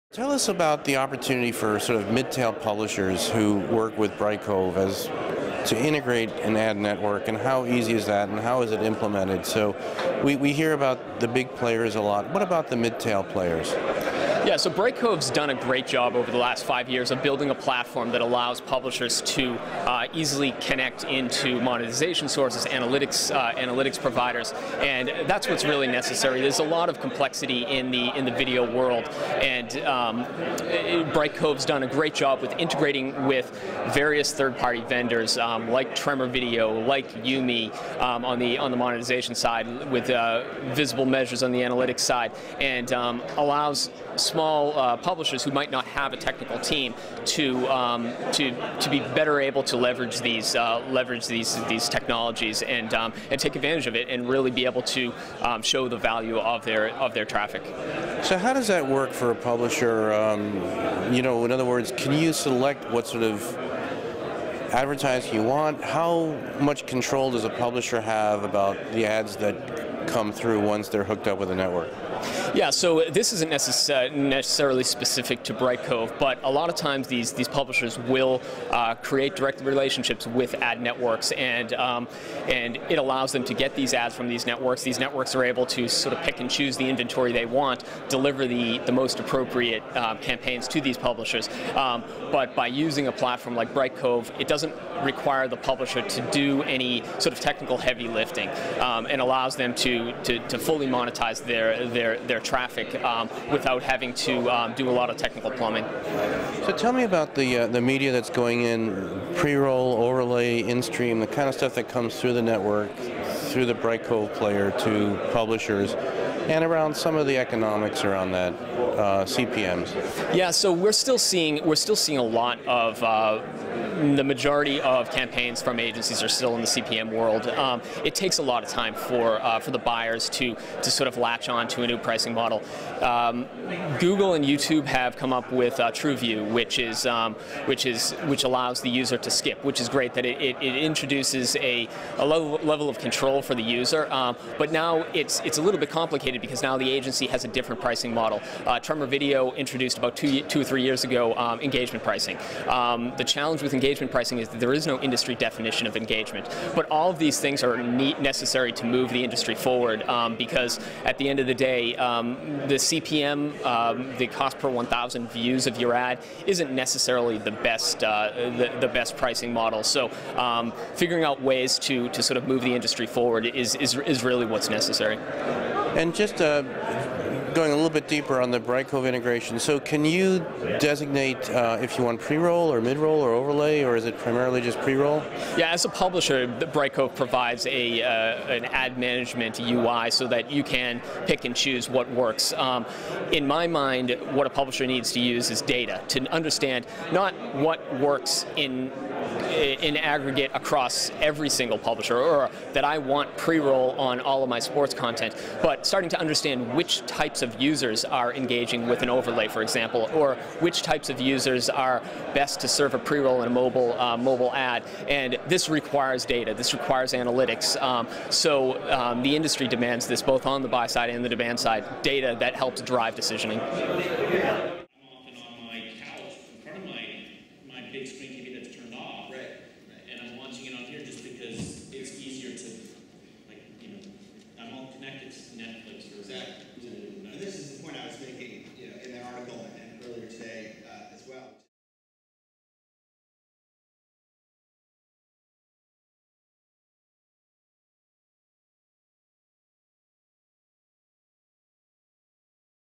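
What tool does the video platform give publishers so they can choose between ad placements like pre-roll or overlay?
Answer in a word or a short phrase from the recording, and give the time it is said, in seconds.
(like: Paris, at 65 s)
ad management UI, at 188 s.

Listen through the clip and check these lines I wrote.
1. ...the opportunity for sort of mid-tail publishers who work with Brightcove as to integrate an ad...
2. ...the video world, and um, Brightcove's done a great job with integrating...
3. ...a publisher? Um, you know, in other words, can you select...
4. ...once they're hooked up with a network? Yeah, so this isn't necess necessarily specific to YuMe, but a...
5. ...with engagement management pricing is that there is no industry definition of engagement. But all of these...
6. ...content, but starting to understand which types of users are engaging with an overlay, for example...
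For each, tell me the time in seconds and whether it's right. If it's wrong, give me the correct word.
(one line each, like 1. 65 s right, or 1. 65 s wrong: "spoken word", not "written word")
1. 0 s right
2. 28 s right
3. 59 s right
4. 70 s wrong: "Brightcove", not "YuMe"
5. 153 s wrong: "engagement", not "management"
6. 204 s right.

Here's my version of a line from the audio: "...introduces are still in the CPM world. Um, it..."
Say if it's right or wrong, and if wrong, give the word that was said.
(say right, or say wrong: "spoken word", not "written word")
wrong: "agencies", not "introduces".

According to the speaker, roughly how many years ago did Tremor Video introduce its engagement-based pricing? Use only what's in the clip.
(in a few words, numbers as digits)
2 or 3 years.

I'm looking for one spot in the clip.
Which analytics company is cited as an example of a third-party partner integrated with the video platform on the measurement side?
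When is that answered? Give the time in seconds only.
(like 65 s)
40 s.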